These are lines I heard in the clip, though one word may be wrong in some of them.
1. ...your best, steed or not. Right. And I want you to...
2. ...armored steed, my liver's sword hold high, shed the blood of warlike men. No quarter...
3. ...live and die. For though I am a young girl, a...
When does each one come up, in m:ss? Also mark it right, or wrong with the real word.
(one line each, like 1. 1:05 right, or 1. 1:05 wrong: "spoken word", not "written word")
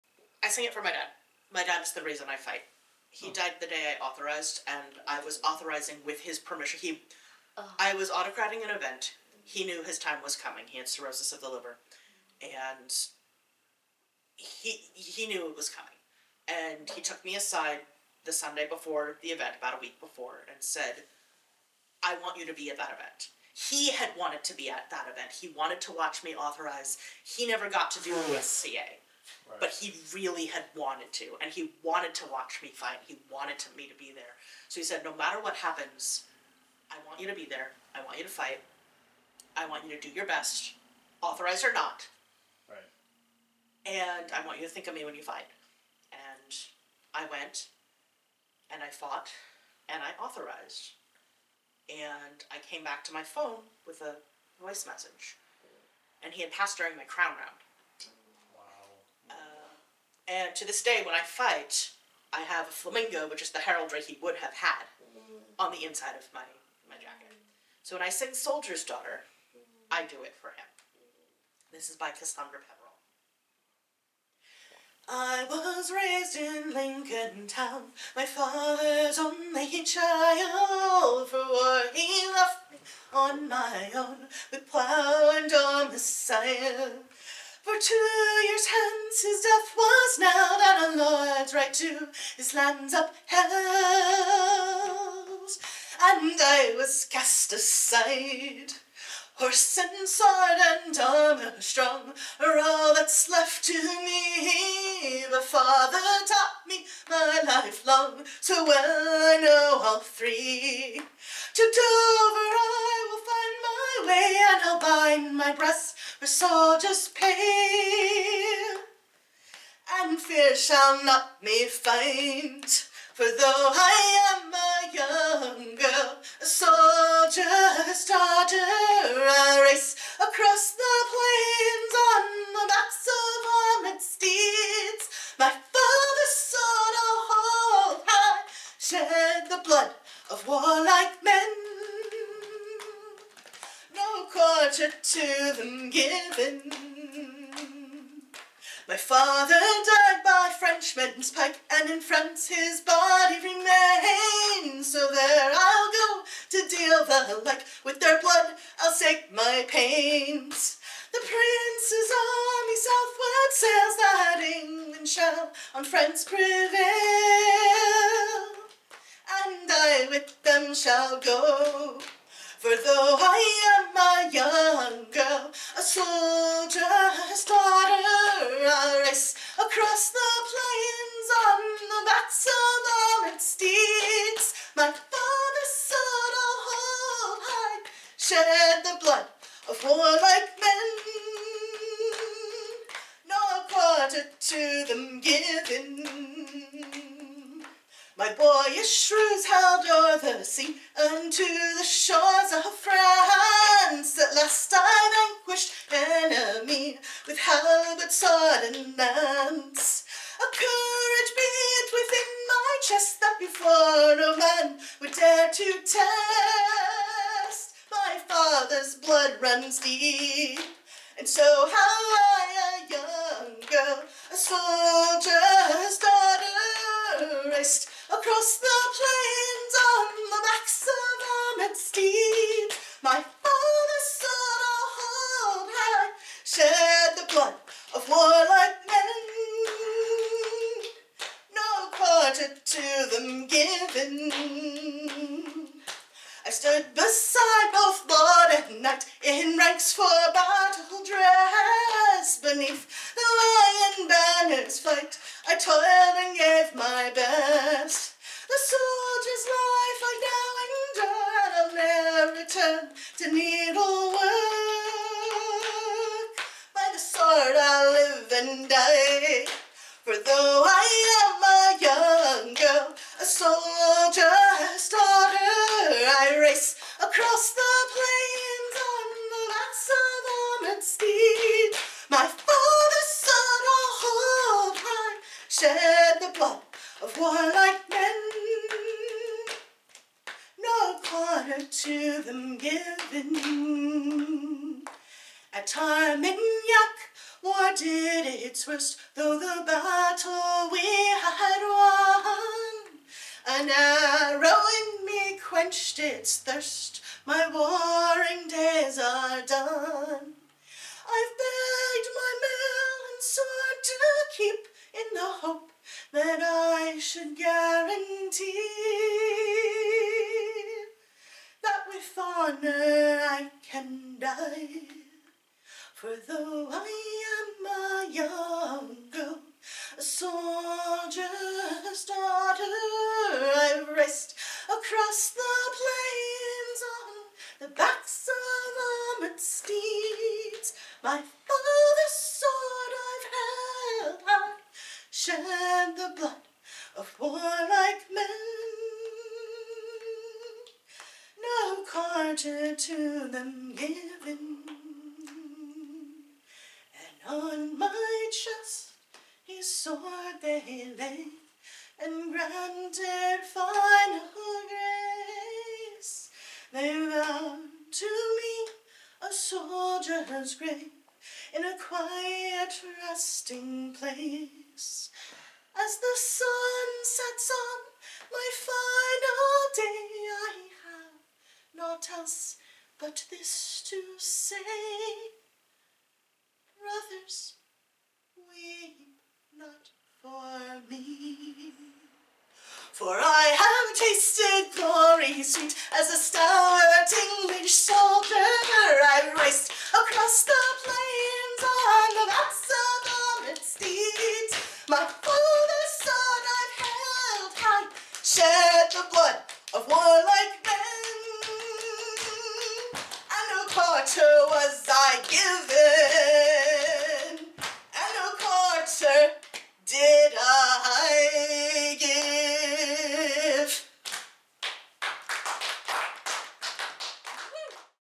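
1. 0:40 wrong: "authorized", not "steed"
2. 3:51 wrong: "father", not "liver"
3. 4:27 right.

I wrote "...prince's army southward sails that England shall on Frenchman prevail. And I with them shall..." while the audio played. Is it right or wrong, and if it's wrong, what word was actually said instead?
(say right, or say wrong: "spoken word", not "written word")
wrong: "France", not "Frenchman".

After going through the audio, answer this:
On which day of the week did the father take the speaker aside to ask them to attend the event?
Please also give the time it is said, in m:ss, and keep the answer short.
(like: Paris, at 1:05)
Sunday, at 0:18.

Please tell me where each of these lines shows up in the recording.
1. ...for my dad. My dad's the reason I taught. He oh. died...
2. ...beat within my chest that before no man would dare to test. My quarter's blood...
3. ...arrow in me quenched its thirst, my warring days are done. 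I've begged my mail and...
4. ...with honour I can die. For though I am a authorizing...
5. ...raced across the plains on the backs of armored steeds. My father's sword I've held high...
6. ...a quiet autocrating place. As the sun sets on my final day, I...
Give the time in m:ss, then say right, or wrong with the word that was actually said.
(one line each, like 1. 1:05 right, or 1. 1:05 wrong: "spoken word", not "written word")
1. 0:00 wrong: "fight", not "taught"
2. 3:31 wrong: "father", not "quarter"
3. 5:03 right
4. 5:21 wrong: "young", not "authorizing"
5. 5:33 right
6. 6:11 wrong: "resting", not "autocrating".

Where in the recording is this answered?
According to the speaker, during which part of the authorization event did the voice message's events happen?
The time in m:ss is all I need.
0:57.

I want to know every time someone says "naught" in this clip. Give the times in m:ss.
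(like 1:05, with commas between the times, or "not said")
6:21.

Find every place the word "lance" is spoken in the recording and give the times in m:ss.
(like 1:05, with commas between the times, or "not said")
3:28.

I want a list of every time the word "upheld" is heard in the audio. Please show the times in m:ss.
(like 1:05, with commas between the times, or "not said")
1:32.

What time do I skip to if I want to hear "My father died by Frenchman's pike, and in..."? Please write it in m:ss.
2:28.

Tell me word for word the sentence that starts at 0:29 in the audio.
But he really had wanted to, and he wanted to watch me fight.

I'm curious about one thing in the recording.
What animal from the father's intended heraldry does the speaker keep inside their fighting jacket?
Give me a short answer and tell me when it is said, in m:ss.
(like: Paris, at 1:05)
Flamingo, at 1:02.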